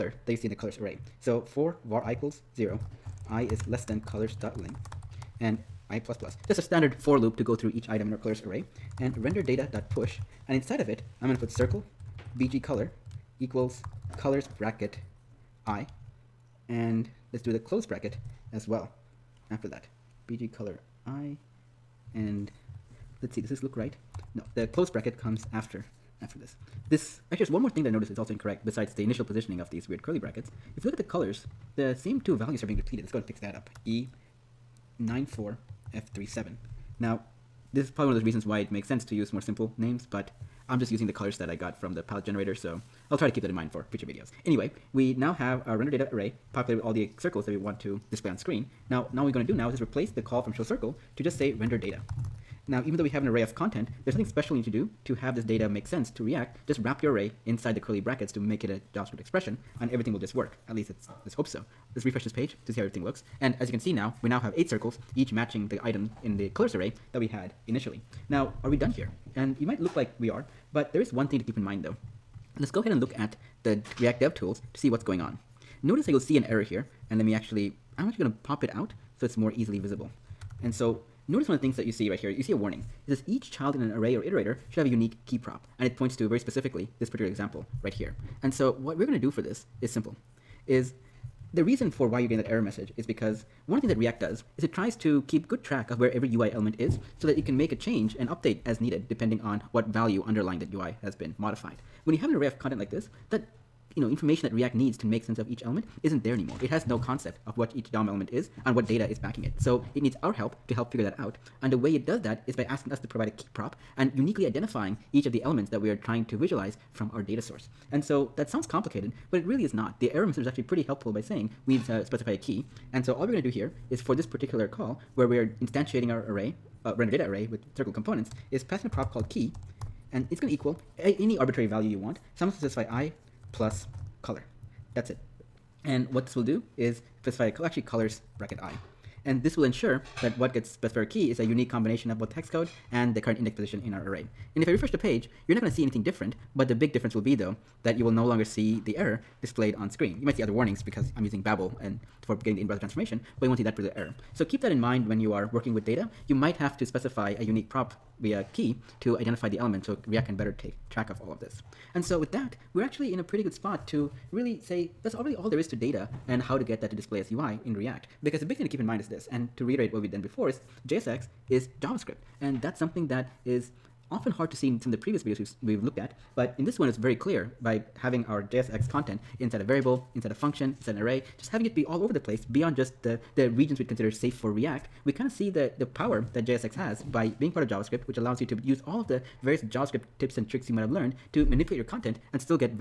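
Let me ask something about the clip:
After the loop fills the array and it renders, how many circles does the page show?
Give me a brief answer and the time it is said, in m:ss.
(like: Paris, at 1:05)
8, at 1:04.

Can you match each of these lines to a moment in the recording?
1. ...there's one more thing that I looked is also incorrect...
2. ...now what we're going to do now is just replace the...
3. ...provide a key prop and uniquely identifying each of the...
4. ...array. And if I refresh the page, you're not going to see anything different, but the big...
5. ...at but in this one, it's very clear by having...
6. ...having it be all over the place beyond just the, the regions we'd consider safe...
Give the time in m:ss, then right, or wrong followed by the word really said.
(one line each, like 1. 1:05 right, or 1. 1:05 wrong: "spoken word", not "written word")
1. 0:27 wrong: "noticed", not "looked"
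2. 0:49 right
3. 1:53 right
4. 2:24 right
5. 2:55 right
6. 3:01 right.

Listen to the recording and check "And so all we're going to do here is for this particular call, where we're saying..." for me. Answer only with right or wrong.
wrong.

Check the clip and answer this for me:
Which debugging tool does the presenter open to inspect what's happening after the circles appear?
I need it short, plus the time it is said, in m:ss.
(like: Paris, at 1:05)
React Dev Tools, at 1:13.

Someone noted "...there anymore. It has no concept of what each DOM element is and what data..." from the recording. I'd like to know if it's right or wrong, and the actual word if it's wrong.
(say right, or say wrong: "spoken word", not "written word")
right.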